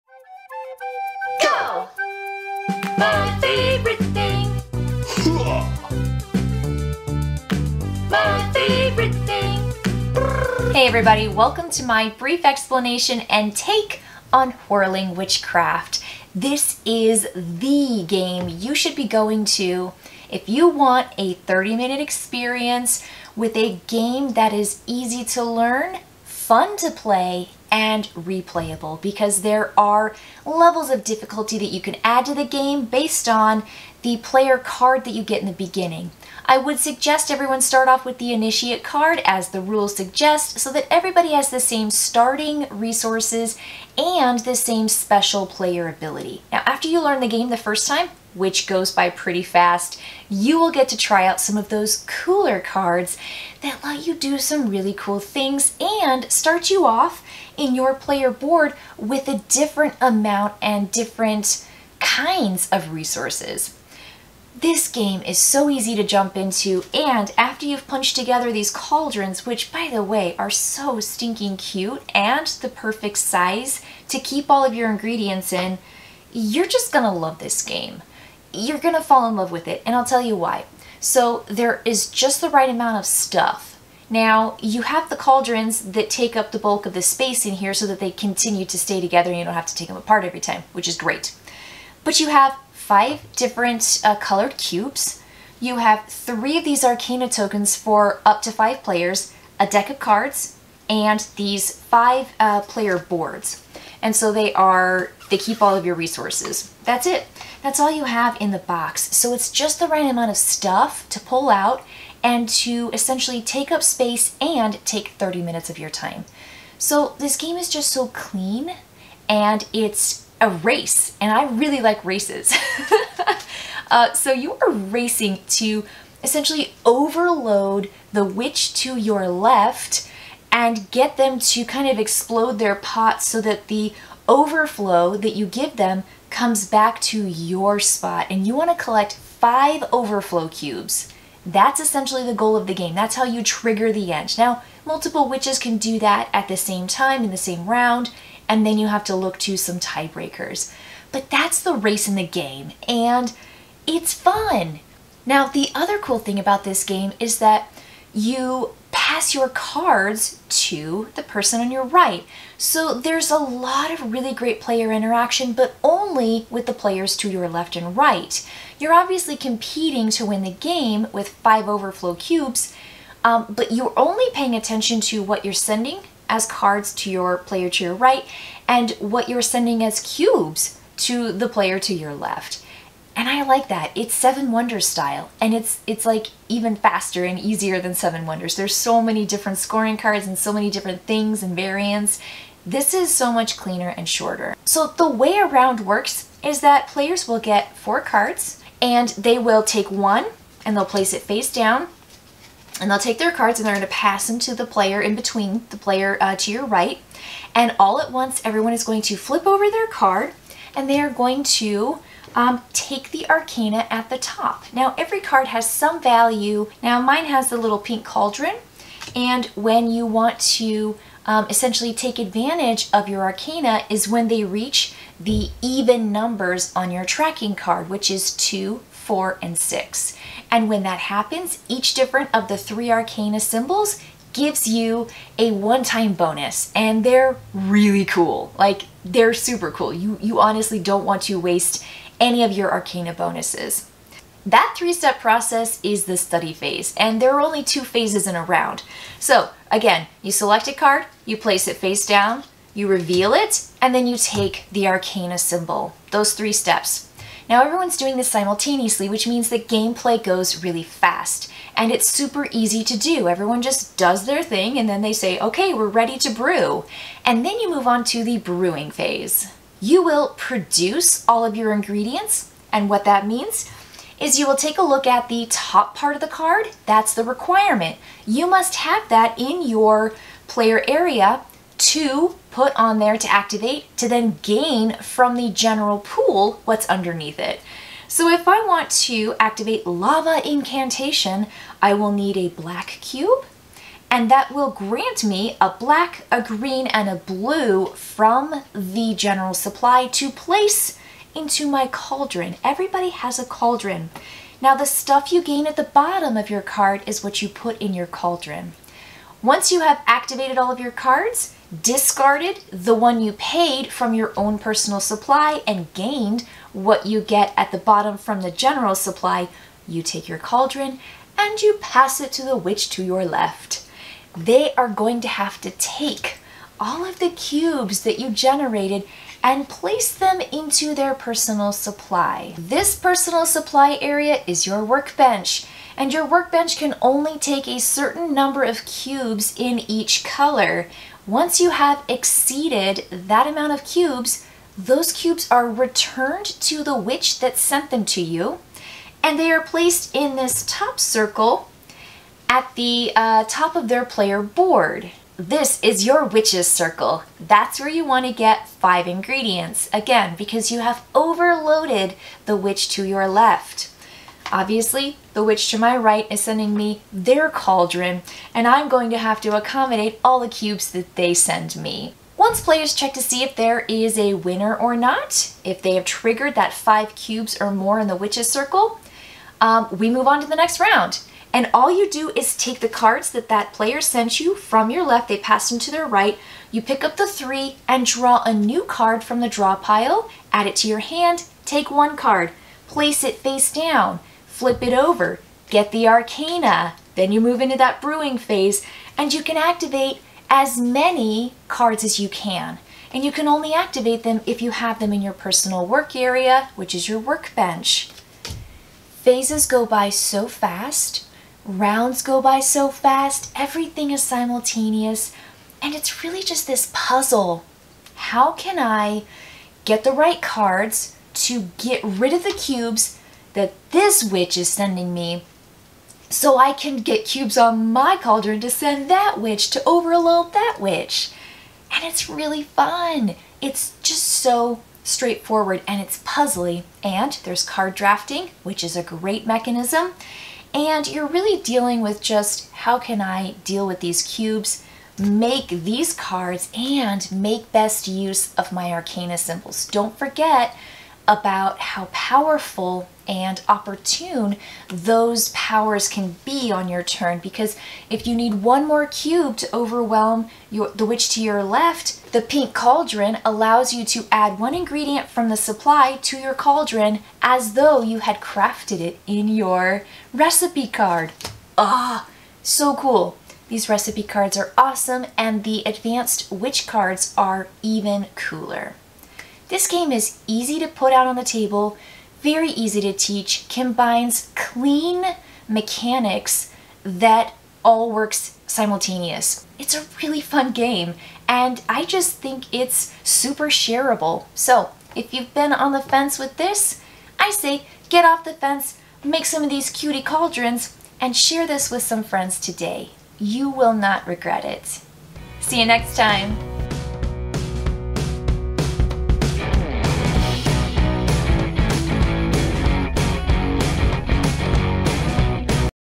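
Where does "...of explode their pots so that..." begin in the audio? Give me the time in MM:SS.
02:11.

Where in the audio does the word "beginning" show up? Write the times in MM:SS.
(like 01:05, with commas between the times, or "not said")
00:35.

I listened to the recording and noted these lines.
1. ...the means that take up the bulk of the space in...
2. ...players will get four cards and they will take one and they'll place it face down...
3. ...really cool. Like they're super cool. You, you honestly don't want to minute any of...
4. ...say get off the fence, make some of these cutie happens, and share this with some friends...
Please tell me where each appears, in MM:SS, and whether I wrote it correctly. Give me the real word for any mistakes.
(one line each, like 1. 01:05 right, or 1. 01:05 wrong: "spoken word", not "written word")
1. 01:25 wrong: "cauldrons", not "means"
2. 03:16 right
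3. 03:57 wrong: "waste", not "minute"
4. 08:17 wrong: "cauldrons", not "happens".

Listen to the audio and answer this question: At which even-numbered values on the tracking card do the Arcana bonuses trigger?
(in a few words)
2, 4, and 6.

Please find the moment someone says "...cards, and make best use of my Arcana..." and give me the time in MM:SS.
07:26.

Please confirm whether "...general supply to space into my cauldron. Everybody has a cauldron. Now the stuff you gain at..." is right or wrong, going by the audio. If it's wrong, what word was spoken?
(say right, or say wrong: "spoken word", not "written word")
wrong: "place", not "space".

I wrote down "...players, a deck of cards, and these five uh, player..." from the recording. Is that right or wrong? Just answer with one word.
right.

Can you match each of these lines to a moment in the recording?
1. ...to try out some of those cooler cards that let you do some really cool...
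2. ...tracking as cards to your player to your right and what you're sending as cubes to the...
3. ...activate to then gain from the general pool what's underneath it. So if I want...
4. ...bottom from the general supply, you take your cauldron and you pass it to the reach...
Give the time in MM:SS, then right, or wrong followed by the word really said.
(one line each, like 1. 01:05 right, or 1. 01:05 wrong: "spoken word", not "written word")
1. 00:50 right
2. 02:55 wrong: "sending", not "tracking"
3. 04:43 right
4. 05:17 wrong: "witch", not "reach".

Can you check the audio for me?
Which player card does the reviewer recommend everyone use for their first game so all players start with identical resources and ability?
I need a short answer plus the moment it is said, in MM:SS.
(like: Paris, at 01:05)
Initiate card, at 00:38.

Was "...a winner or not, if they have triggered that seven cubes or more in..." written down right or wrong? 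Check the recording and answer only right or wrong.
wrong.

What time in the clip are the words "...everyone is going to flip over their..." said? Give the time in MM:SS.
03:28.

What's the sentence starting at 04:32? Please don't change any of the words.
And what that means is you will take a look at the top part of the card.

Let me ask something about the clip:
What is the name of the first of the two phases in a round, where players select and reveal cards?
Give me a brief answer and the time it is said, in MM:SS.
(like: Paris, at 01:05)
Study phase, at 04:06.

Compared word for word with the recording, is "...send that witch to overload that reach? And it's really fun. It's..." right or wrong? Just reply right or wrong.
wrong.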